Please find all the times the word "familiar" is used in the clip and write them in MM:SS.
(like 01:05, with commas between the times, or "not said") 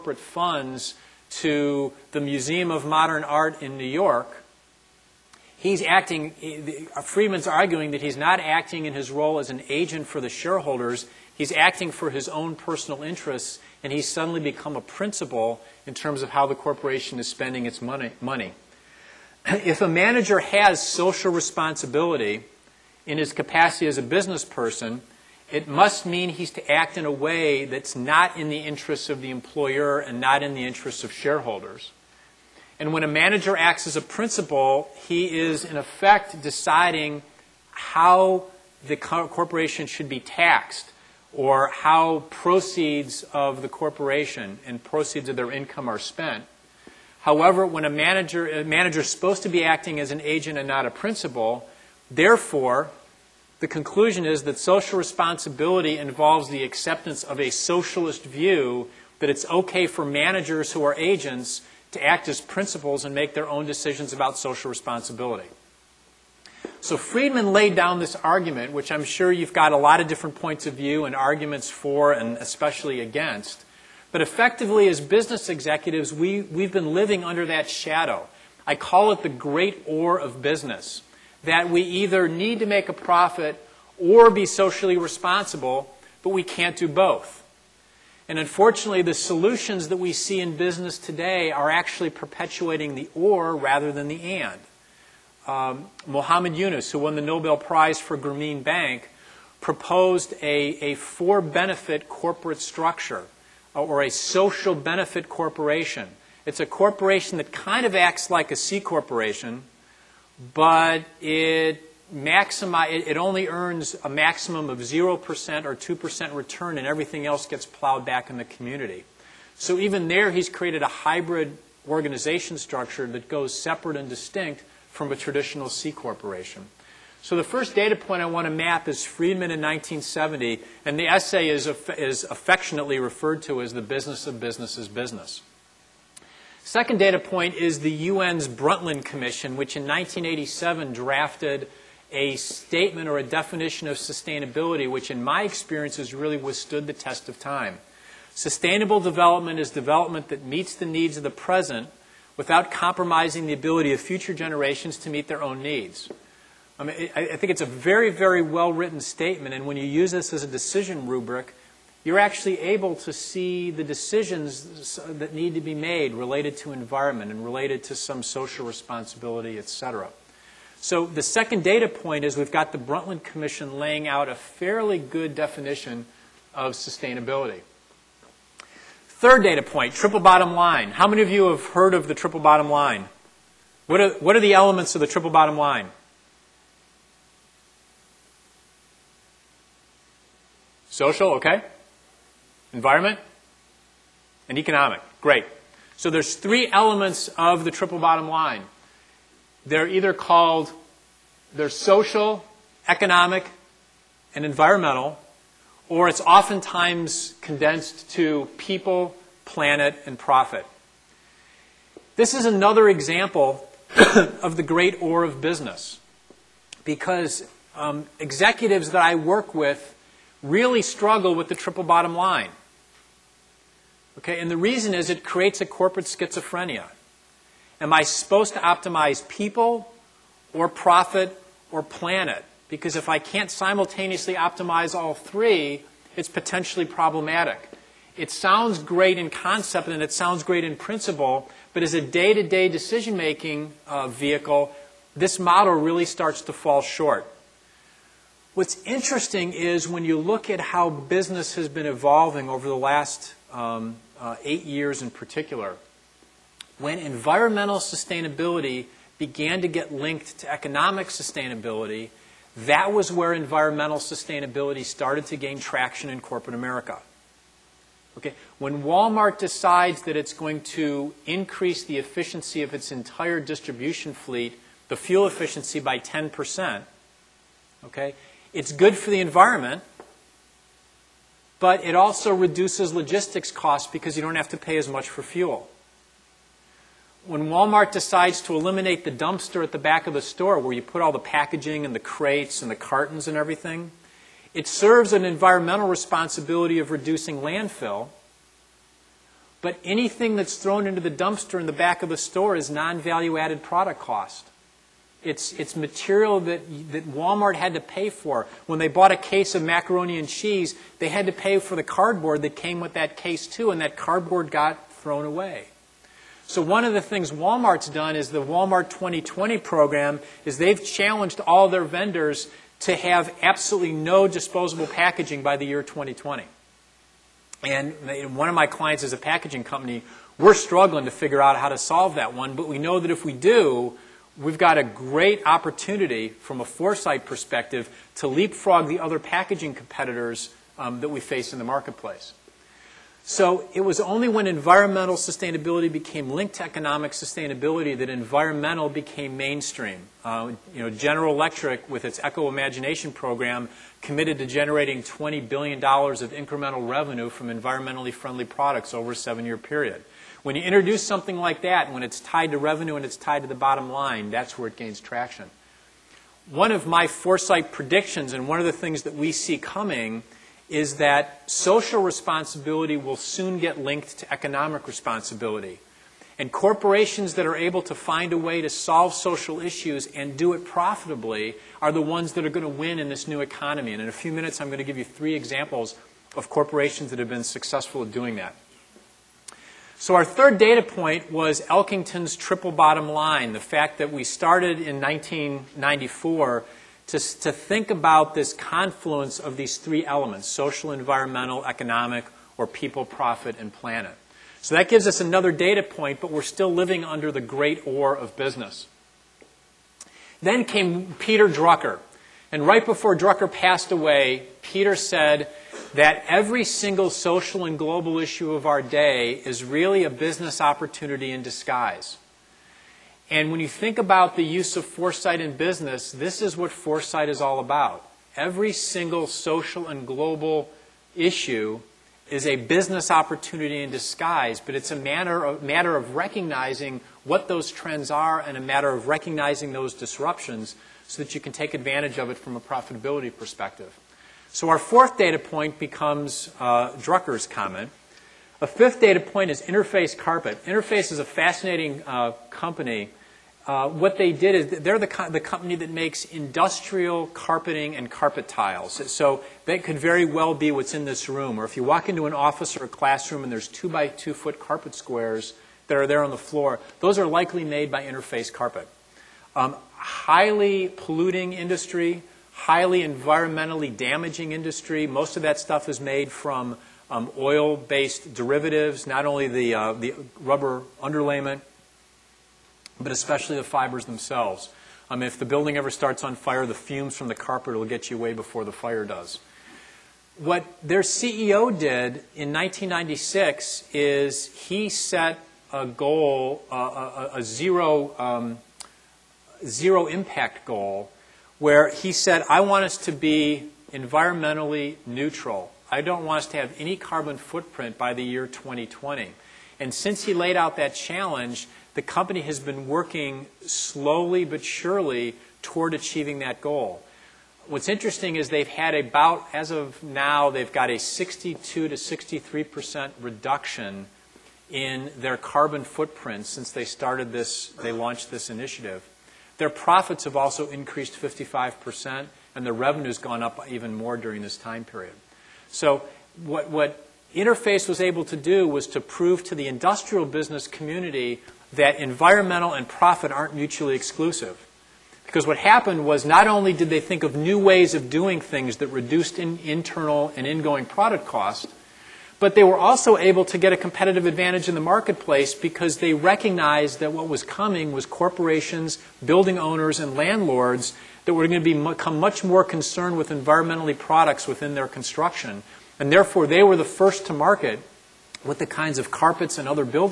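not said.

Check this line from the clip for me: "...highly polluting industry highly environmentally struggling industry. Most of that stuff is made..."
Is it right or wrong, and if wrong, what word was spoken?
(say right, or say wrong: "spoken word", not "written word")
wrong: "damaging", not "struggling".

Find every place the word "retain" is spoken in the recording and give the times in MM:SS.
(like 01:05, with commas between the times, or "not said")
not said.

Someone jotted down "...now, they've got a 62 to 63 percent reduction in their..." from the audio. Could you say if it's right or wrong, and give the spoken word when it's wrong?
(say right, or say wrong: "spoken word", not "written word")
right.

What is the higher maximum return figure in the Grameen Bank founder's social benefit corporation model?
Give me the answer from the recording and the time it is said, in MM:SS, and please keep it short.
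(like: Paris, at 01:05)
2%, at 01:55.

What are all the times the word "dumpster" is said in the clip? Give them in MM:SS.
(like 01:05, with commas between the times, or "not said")
04:49, 05:01.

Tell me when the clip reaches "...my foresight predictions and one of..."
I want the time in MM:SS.
06:06.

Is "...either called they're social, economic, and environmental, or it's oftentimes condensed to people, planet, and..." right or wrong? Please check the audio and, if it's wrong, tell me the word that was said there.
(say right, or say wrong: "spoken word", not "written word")
right.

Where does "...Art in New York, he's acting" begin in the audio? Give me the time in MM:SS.
00:03.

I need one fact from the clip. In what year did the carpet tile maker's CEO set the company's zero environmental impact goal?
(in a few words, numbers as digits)
1996.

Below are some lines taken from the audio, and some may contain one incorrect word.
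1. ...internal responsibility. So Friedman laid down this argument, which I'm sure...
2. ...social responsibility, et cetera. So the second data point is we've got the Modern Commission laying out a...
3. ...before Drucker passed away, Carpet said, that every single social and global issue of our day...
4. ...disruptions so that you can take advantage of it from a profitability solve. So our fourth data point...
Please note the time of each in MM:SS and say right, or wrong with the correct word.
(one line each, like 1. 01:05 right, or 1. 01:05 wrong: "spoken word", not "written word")
1. 01:04 wrong: "social", not "internal"
2. 02:48 wrong: "Brundtland", not "Modern"
3. 06:52 wrong: "Peter", not "Carpet"
4. 07:19 wrong: "perspective", not "solve".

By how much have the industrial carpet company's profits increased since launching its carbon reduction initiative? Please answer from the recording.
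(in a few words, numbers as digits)
55%.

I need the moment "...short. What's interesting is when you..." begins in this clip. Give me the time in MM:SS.
04:06.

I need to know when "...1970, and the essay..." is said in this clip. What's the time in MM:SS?
02:09.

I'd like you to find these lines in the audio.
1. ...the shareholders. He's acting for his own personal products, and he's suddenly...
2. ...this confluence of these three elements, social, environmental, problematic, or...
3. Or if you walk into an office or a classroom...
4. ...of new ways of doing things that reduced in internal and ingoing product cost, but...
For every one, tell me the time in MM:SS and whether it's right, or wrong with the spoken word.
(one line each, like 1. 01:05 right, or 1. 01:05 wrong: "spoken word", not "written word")
1. 00:10 wrong: "interests", not "products"
2. 06:38 wrong: "economic", not "problematic"
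3. 07:41 right
4. 09:07 right.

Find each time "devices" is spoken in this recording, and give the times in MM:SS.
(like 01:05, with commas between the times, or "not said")
not said.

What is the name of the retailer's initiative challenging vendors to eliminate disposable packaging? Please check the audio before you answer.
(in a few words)
Walmart 2020.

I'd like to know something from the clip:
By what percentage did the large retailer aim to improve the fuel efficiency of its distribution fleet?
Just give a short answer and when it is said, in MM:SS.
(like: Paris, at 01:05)
10%, at 04:35.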